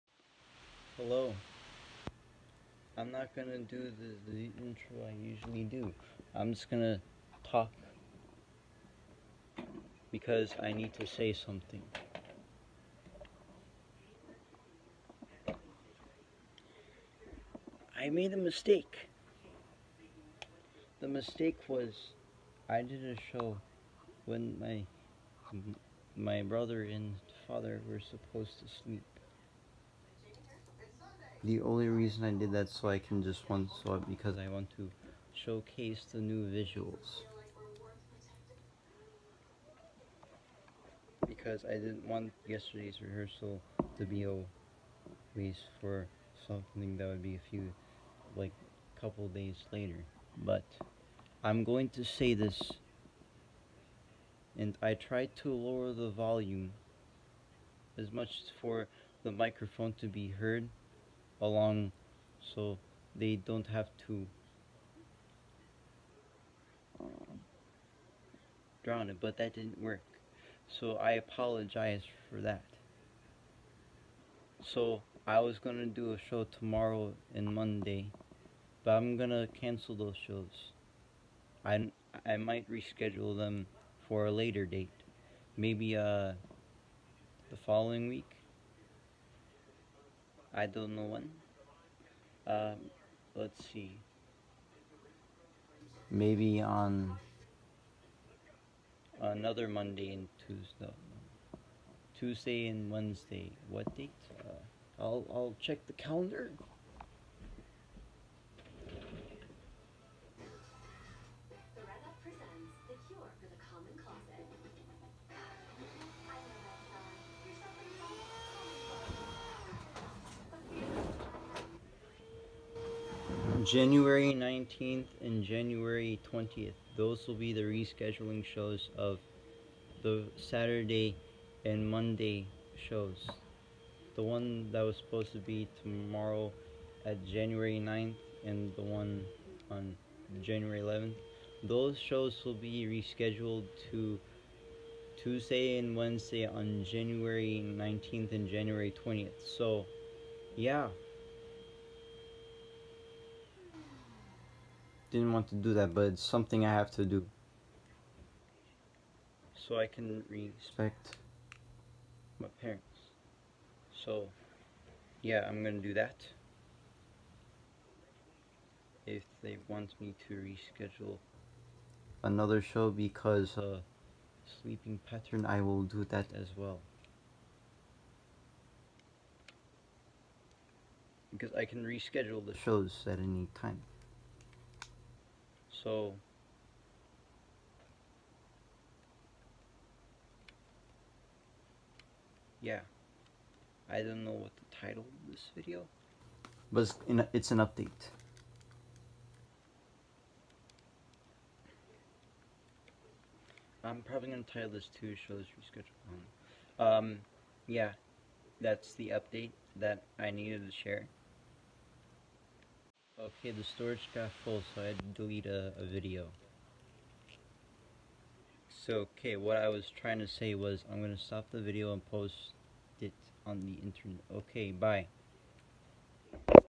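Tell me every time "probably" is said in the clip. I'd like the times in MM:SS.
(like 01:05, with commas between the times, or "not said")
03:24.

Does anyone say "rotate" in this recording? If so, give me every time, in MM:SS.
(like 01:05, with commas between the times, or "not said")
not said.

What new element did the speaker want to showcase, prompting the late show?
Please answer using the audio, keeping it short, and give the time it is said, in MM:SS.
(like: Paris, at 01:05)
new visuals, at 00:36.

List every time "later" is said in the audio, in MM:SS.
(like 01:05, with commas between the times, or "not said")
00:49, 01:24.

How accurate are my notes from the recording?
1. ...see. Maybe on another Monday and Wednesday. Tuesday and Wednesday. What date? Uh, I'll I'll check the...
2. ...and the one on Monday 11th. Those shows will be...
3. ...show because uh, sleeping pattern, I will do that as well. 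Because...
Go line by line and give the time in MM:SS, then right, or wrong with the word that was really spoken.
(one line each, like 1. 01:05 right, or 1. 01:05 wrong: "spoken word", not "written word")
1. 01:33 wrong: "Tuesday", not "Wednesday"
2. 02:18 wrong: "January", not "Monday"
3. 02:52 right.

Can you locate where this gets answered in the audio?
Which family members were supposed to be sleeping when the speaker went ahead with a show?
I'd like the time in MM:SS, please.
00:26.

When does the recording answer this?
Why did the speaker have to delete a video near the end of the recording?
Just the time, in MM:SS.
03:33.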